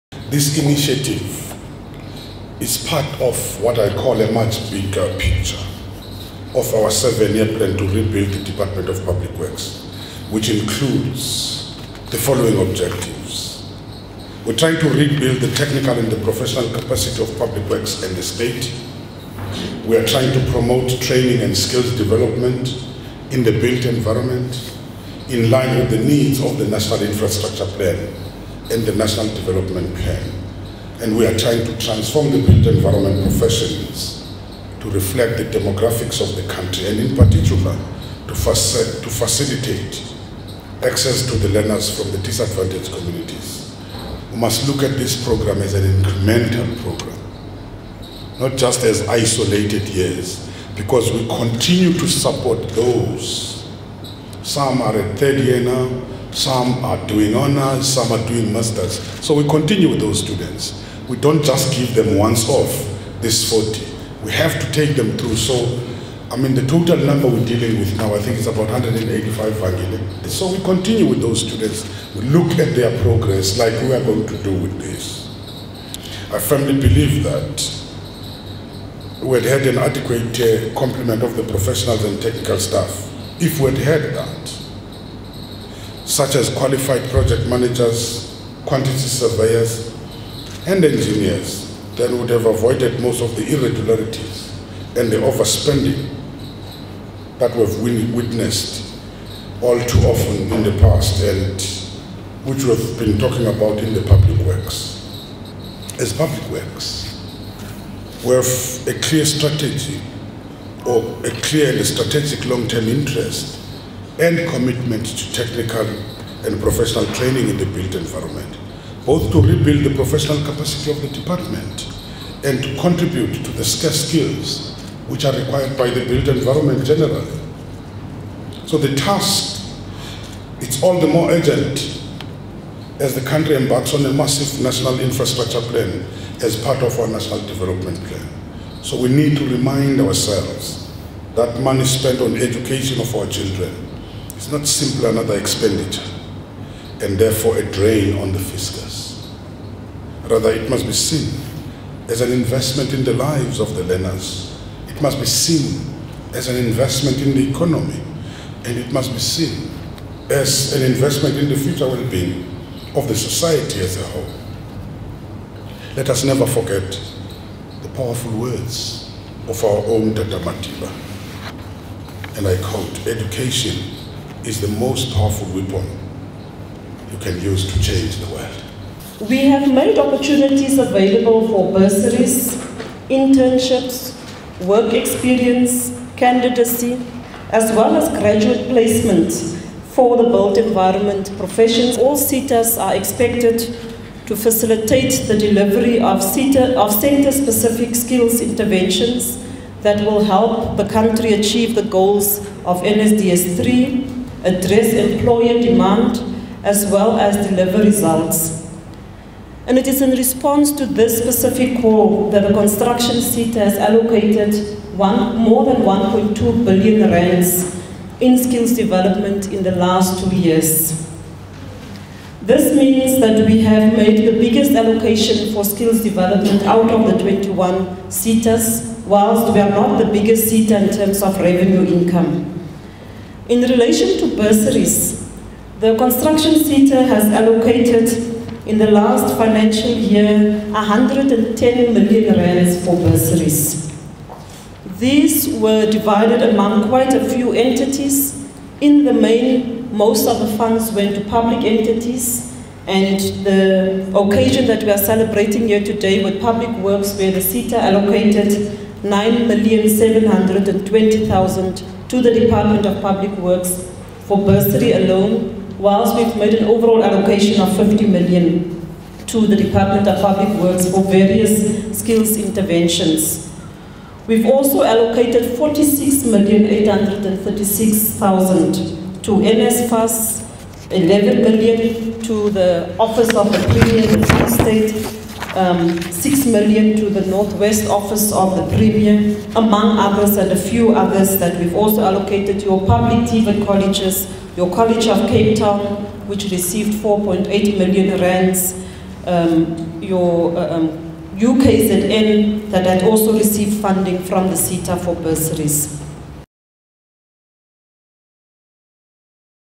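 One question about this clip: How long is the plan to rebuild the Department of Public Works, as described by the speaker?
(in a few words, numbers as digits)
7 years.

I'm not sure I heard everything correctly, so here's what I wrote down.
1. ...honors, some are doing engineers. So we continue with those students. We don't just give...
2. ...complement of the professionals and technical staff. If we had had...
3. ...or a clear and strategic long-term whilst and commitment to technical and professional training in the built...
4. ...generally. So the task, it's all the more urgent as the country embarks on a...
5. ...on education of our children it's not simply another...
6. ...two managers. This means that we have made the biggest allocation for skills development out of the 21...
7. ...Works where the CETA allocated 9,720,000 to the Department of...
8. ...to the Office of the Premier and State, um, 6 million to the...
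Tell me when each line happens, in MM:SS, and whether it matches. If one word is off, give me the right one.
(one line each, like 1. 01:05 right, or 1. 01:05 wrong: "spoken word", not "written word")
1. 00:57 wrong: "masters", not "engineers"
2. 01:20 right
3. 01:50 wrong: "interest", not "whilst"
4. 02:06 right
5. 02:22 right
6. 03:40 wrong: "years", not "managers"
7. 04:16 right
8. 04:42 right.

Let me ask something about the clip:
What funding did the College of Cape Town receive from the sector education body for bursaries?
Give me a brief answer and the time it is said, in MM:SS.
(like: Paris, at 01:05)
4.8 million rands, at 04:57.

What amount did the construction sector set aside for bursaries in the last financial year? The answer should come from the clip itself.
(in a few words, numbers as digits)
110 million rands.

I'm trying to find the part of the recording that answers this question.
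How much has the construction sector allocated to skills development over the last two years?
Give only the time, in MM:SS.
03:35.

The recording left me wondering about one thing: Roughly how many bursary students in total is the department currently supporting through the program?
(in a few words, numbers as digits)
185.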